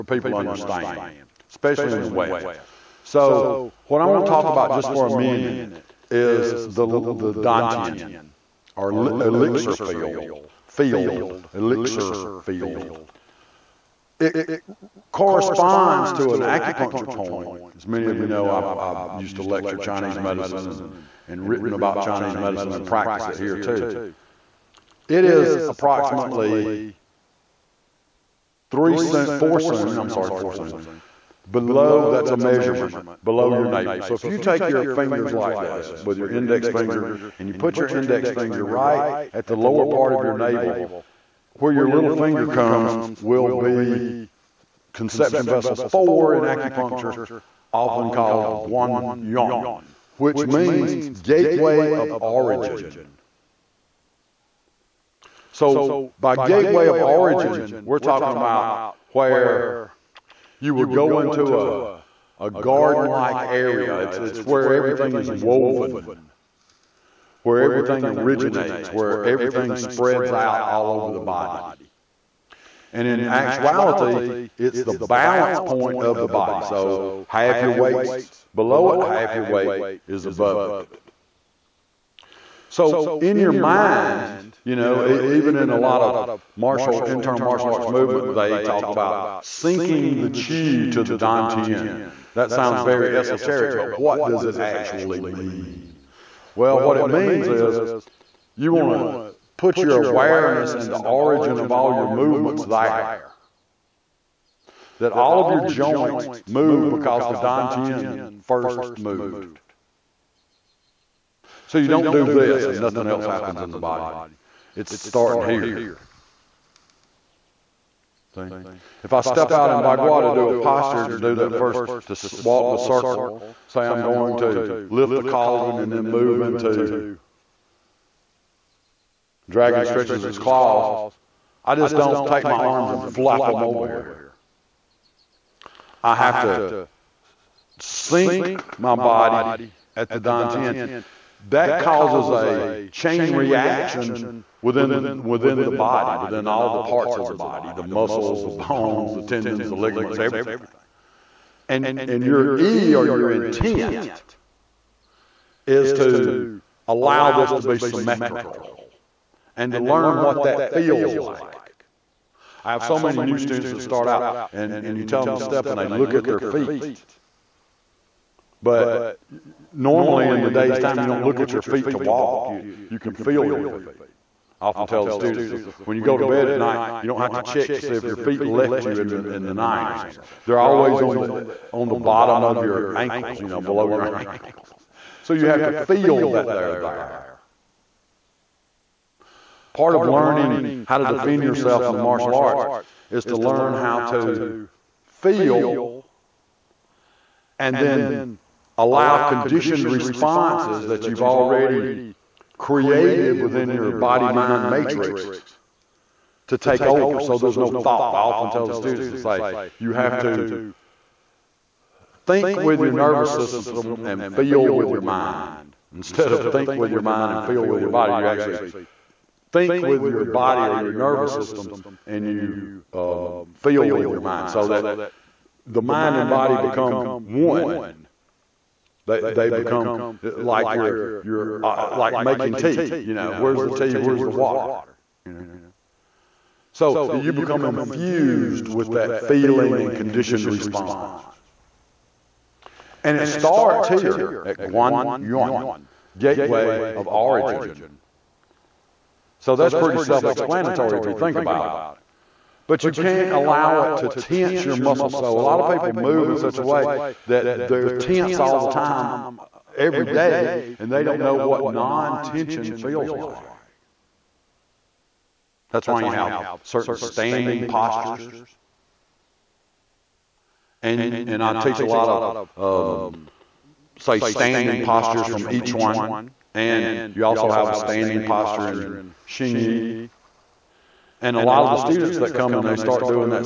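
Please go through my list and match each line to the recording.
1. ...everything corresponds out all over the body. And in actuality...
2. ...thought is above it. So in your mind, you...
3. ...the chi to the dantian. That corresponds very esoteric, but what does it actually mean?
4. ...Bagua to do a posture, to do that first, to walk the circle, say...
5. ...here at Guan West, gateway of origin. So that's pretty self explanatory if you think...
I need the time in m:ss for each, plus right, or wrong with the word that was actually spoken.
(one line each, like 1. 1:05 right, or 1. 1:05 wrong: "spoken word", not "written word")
1. 1:09 wrong: "spreads", not "corresponds"
2. 1:19 wrong: "weight", not "thought"
3. 1:30 wrong: "sounds", not "corresponds"
4. 1:59 right
5. 4:03 wrong: "Yuan", not "West".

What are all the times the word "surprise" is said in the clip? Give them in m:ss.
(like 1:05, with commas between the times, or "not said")
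not said.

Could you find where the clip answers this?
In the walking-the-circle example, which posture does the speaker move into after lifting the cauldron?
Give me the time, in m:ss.
2:09.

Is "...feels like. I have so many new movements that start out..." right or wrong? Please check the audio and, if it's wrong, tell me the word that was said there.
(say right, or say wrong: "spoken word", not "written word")
wrong: "students", not "movements".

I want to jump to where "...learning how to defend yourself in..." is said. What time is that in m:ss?
3:10.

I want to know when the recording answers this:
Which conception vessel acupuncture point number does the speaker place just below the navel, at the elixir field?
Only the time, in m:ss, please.
0:44.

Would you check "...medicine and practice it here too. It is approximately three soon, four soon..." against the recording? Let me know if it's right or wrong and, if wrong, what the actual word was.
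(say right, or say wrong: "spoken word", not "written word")
right.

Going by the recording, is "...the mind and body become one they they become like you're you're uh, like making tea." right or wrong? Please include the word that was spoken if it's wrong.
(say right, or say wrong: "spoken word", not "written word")
right.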